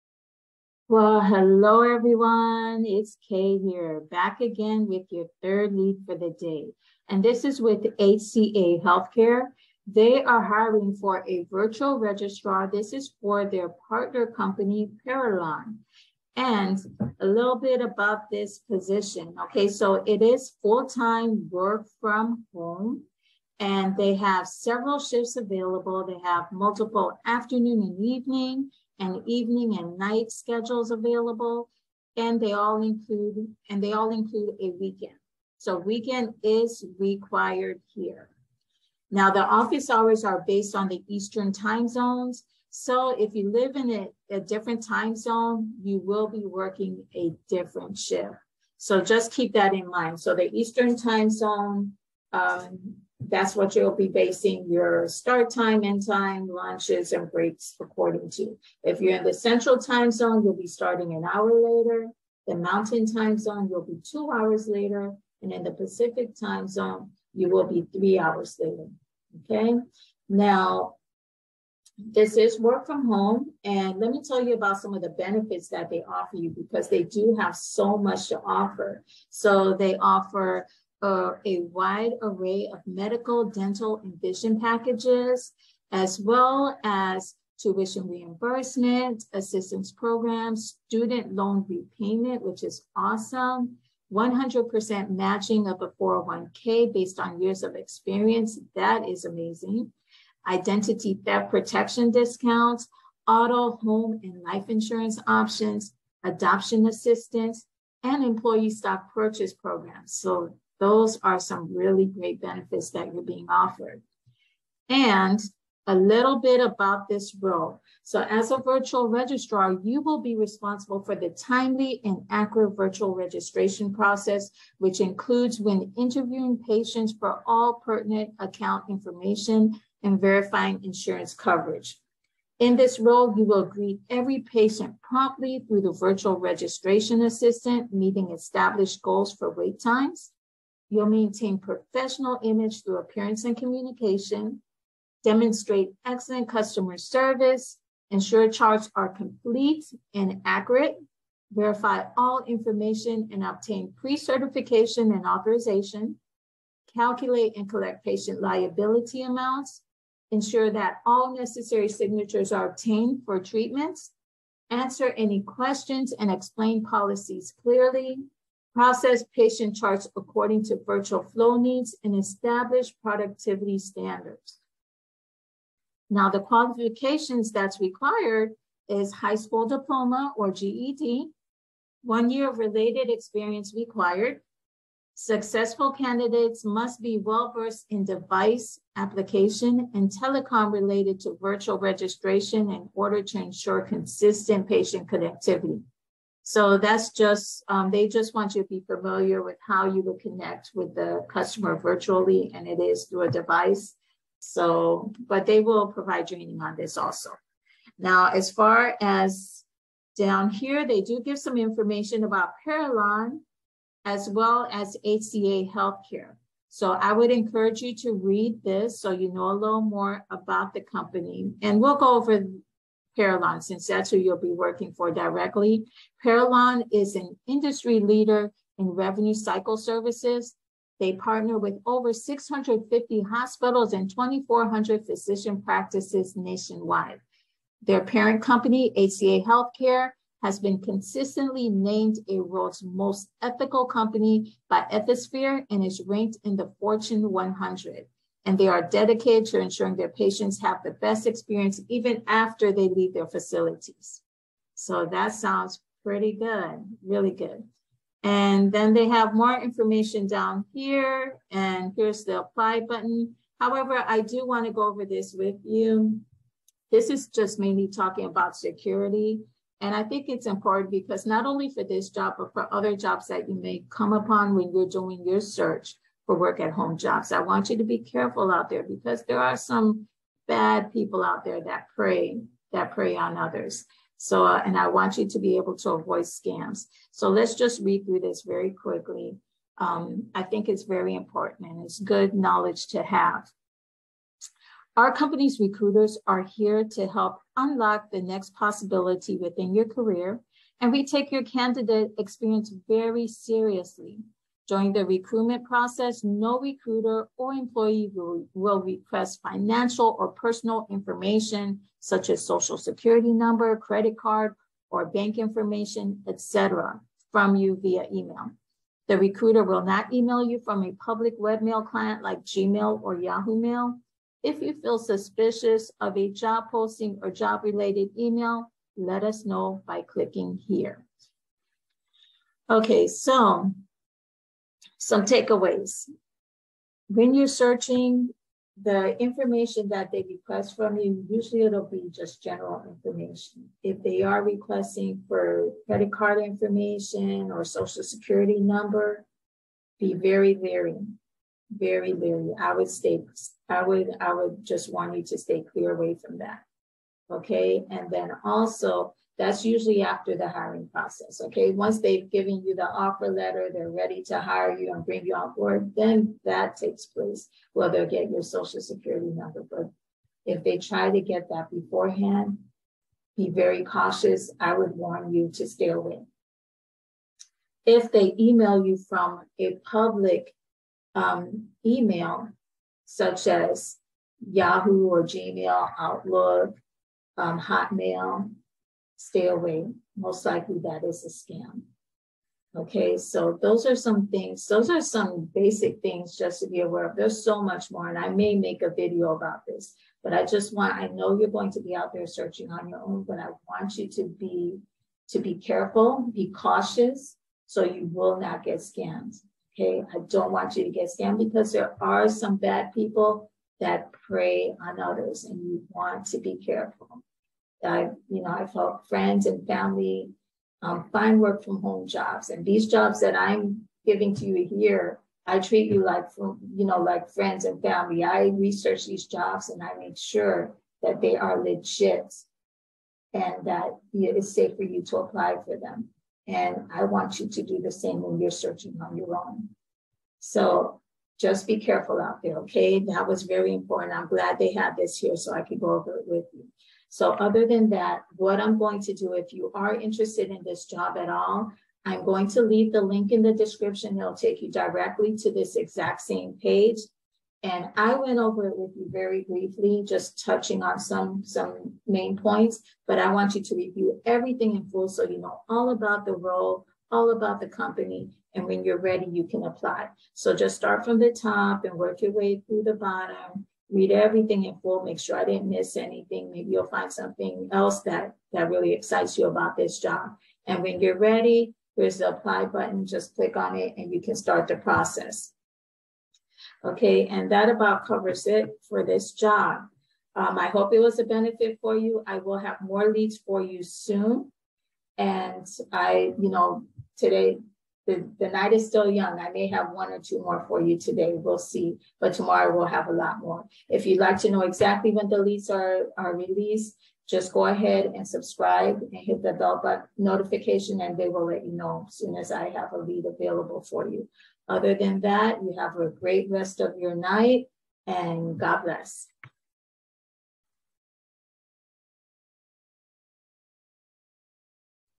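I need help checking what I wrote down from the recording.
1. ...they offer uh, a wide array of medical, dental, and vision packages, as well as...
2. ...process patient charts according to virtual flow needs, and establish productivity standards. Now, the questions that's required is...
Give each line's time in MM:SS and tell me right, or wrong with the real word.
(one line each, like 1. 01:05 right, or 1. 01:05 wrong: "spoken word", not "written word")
1. 01:19 right
2. 02:48 wrong: "qualifications", not "questions".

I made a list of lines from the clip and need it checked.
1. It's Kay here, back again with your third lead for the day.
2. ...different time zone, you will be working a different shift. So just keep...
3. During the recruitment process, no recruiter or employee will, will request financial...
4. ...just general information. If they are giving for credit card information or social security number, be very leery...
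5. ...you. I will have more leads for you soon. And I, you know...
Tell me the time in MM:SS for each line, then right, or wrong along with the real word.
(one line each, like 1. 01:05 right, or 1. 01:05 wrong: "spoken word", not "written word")
1. 00:02 right
2. 00:44 right
3. 05:04 right
4. 05:42 wrong: "requesting", not "giving"
5. 08:11 right.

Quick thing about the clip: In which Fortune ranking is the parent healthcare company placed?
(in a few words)
Fortune 100.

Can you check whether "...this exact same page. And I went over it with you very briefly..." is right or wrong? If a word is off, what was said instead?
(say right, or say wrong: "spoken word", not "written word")
right.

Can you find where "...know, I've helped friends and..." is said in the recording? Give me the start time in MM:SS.
06:58.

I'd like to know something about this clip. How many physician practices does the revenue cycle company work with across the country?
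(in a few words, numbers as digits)
2,400.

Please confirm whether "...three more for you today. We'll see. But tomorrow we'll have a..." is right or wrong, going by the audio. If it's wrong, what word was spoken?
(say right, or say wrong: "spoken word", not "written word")
wrong: "two", not "three".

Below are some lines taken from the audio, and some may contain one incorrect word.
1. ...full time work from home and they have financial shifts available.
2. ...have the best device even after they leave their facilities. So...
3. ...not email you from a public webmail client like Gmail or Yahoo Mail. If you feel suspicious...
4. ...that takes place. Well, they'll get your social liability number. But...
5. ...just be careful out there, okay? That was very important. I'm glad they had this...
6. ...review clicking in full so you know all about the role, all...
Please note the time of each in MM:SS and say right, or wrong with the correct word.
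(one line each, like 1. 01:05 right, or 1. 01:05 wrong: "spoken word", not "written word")
1. 00:20 wrong: "several", not "financial"
2. 04:10 wrong: "experience", not "device"
3. 05:19 right
4. 06:06 wrong: "security", not "liability"
5. 07:21 right
6. 07:43 wrong: "everything", not "clicking".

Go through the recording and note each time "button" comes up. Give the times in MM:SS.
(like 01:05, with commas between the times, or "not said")
04:22, 08:02, 08:29.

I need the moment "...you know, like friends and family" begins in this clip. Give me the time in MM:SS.
07:06.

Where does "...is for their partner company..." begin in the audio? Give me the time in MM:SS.
00:12.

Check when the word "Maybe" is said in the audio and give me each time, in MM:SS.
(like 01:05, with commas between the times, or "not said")
07:56.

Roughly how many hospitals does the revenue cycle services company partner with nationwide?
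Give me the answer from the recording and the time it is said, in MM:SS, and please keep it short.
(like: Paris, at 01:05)
650, at 03:52.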